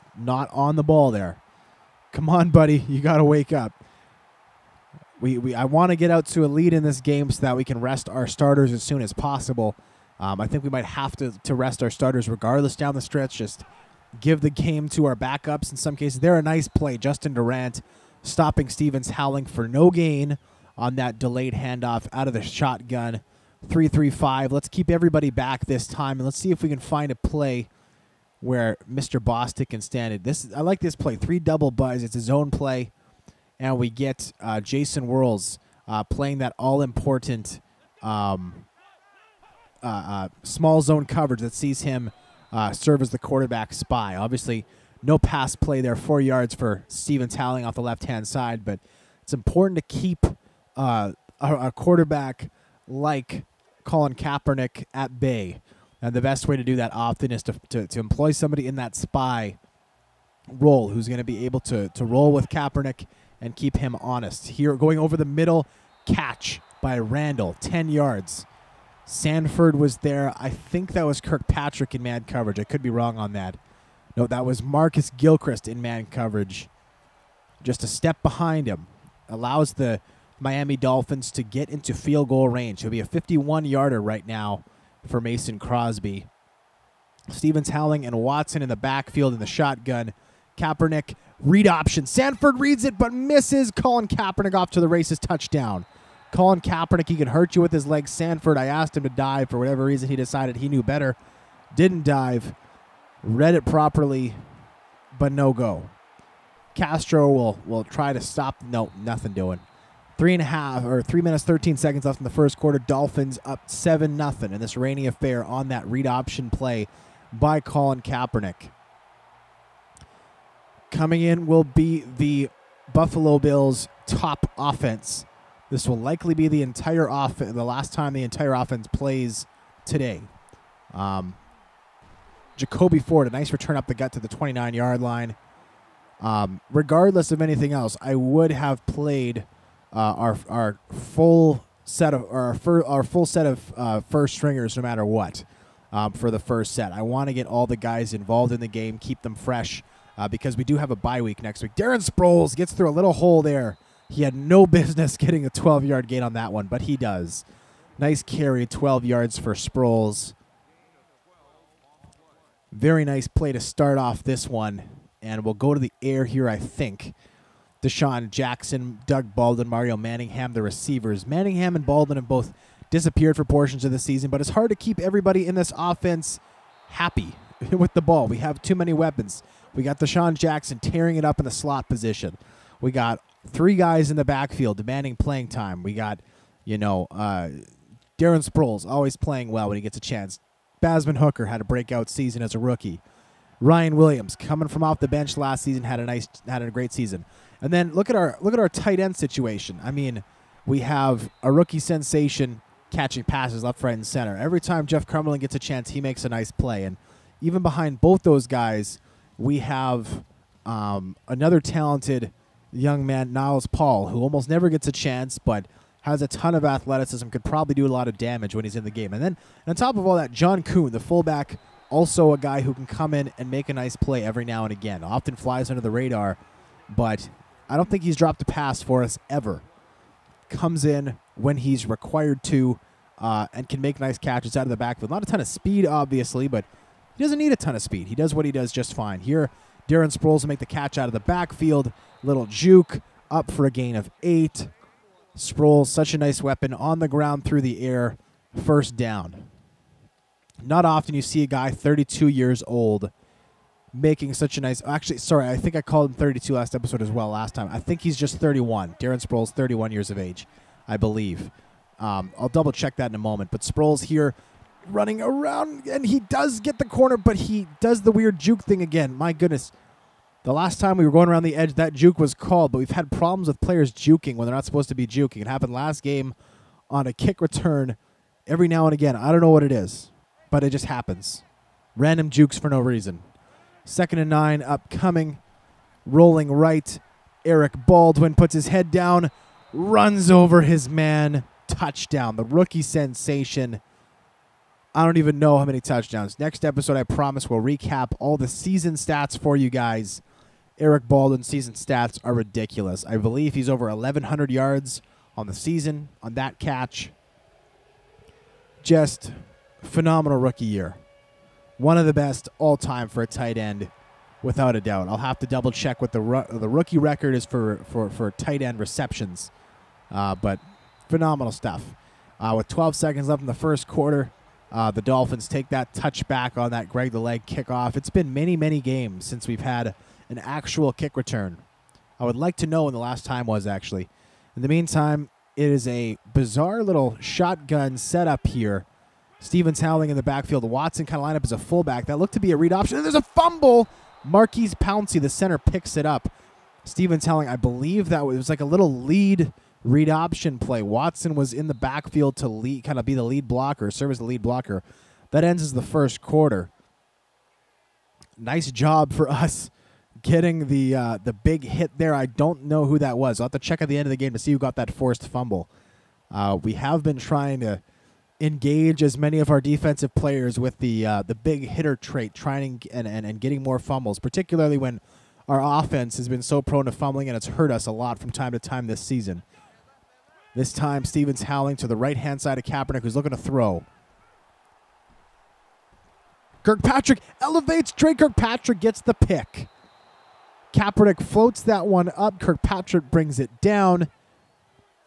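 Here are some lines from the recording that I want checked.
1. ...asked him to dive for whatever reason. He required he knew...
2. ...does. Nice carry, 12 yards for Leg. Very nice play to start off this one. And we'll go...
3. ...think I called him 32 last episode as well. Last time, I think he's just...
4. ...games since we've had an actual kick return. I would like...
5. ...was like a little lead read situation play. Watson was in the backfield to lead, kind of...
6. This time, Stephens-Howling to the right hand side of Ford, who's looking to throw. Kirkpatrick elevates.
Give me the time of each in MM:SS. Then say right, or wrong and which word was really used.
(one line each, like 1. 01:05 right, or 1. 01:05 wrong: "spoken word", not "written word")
1. 01:38 wrong: "decided", not "required"
2. 02:36 wrong: "Sproles", not "Leg"
3. 04:15 right
4. 05:28 right
5. 05:48 wrong: "option", not "situation"
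6. 06:20 wrong: "Kaepernick", not "Ford".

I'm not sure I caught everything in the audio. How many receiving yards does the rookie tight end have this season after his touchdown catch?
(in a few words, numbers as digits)
over 1,100.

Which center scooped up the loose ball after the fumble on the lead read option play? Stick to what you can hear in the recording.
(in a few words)
Maurkice Pouncey.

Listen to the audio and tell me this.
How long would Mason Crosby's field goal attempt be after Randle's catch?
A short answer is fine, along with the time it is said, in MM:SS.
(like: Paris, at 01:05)
51 yards, at 01:23.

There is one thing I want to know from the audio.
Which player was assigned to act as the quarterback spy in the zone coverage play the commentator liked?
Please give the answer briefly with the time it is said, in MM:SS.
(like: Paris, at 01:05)
Jason Worilds, at 00:34.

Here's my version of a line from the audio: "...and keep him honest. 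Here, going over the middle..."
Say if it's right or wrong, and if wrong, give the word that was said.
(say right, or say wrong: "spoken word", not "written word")
right.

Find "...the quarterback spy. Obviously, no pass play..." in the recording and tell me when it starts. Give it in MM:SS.
00:43.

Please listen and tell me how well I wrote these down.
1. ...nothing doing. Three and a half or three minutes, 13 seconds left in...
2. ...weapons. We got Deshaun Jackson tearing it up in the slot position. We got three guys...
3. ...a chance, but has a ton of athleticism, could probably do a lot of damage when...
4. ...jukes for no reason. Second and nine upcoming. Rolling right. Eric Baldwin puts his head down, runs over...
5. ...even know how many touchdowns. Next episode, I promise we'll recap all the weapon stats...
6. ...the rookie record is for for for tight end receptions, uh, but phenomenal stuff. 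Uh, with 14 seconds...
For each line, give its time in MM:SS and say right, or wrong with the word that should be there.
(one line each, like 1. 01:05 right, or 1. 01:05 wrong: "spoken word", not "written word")
1. 01:49 right
2. 02:58 right
3. 03:34 right
4. 04:42 right
5. 04:55 wrong: "season", not "weapon"
6. 05:16 wrong: "12", not "14".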